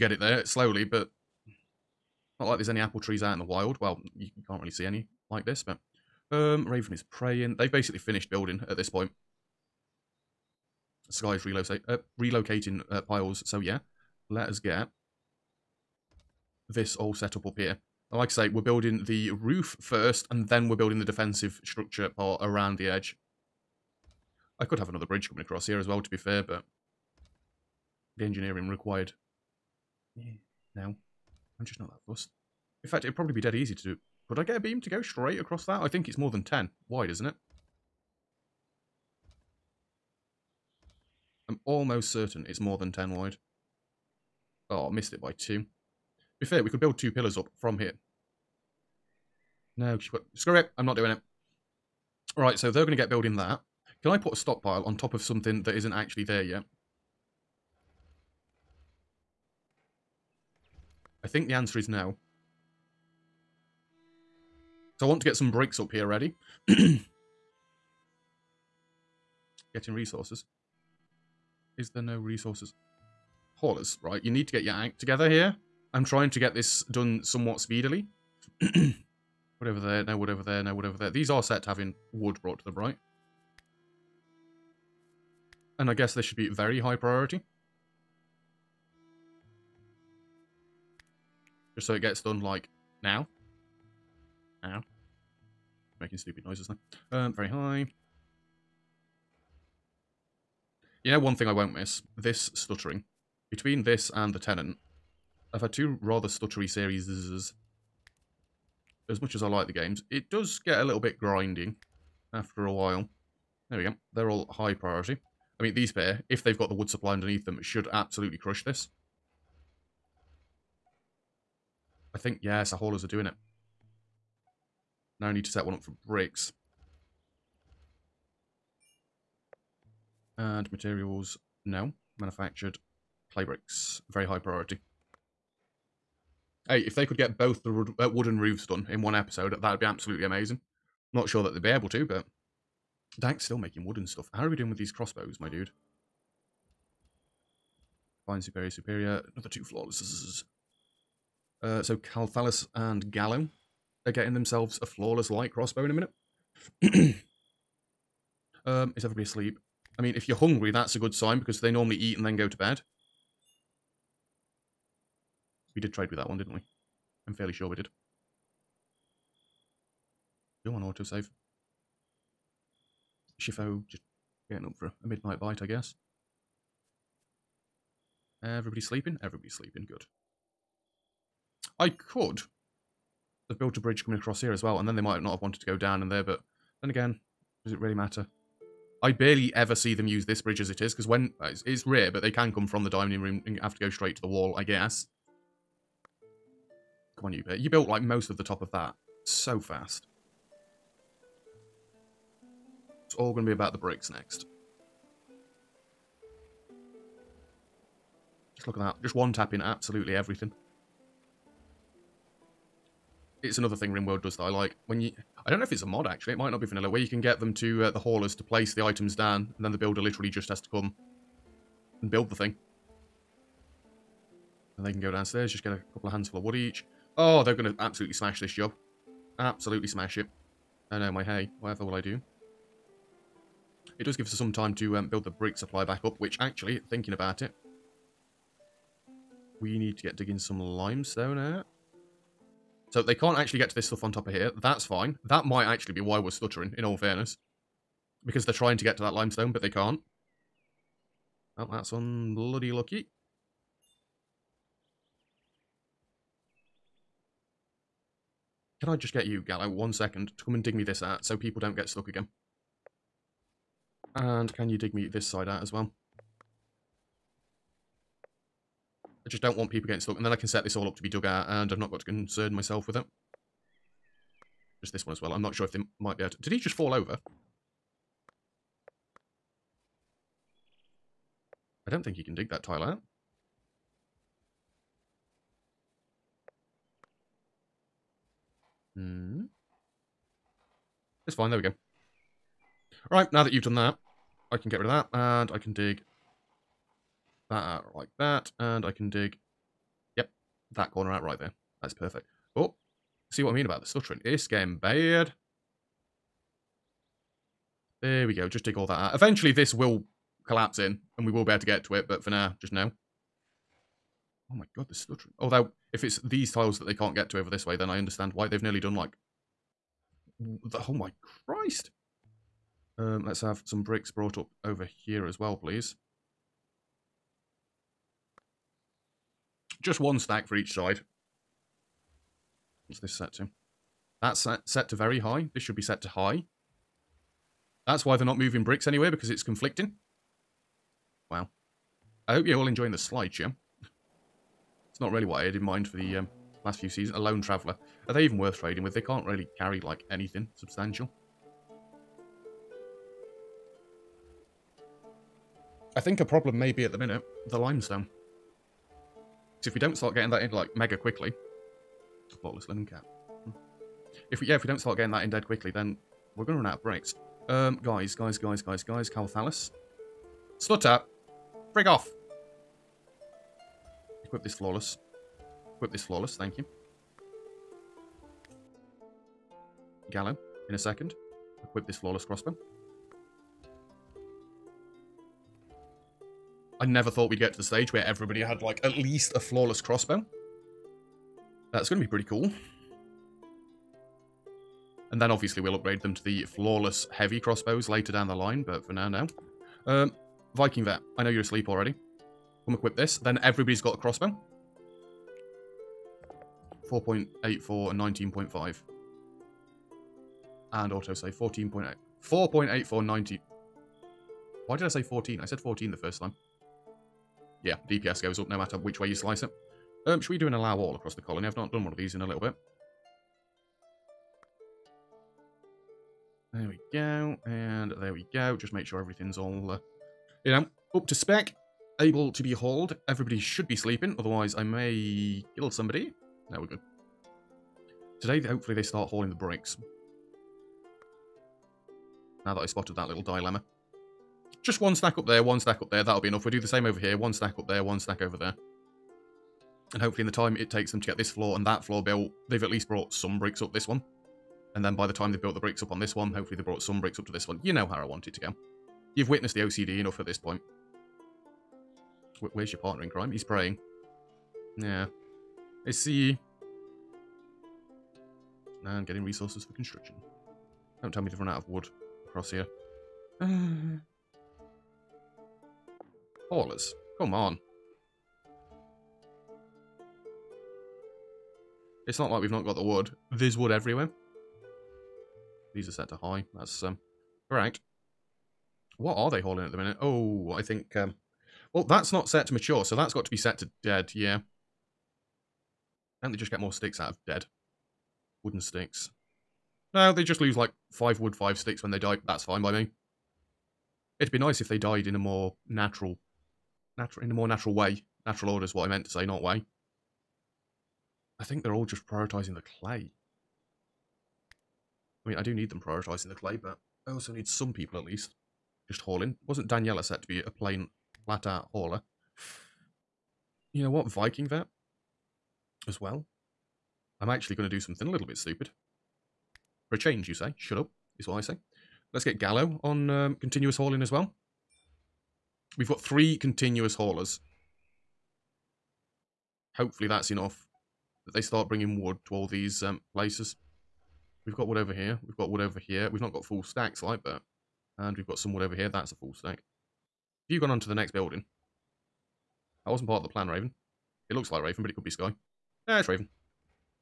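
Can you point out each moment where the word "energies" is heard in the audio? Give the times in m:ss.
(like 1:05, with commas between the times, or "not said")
not said.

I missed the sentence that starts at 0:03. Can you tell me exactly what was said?
Well, you can't really see any like this, but um, Raven is praying.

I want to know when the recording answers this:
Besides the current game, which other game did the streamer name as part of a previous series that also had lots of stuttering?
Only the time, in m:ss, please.
1:44.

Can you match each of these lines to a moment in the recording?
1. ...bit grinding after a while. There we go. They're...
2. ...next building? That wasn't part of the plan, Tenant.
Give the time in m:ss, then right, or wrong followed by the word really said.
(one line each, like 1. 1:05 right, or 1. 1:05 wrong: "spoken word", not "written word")
1. 1:50 right
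2. 9:10 wrong: "Raven", not "Tenant".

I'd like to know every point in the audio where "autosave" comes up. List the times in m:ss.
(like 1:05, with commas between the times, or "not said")
2:50, 6:50.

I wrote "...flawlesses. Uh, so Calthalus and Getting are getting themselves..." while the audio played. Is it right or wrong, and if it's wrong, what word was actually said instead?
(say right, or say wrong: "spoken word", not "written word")
wrong: "Gallo", not "Getting".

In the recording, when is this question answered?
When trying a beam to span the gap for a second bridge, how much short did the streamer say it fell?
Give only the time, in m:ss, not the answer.
0:44.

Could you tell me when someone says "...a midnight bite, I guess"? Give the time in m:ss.
2:55.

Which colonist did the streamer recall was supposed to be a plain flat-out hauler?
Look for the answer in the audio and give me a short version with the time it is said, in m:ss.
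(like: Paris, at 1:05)
Daniela, at 8:39.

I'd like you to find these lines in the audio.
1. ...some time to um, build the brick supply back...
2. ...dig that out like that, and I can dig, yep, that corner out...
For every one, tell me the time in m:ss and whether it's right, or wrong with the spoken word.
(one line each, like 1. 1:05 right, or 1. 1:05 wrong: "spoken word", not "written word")
1. 3:54 right
2. 4:55 right.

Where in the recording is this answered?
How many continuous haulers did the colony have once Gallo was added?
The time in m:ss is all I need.
8:55.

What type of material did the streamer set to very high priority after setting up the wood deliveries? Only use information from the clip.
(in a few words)
Manufactured clay bricks.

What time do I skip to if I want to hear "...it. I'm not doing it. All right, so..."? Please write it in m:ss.
0:50.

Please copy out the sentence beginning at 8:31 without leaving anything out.
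I think they're all just prioritizing the clay.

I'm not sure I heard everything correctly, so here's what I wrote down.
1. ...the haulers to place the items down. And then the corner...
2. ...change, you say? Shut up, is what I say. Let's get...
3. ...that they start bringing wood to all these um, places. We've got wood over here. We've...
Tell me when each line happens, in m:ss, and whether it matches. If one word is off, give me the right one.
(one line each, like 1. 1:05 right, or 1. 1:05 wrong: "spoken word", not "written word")
1. 3:37 wrong: "builder", not "corner"
2. 8:49 right
3. 9:01 right.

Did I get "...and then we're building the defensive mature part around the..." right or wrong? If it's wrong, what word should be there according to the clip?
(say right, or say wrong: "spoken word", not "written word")
wrong: "structure", not "mature".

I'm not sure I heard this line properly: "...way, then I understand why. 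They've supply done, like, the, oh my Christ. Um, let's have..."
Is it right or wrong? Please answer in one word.
wrong.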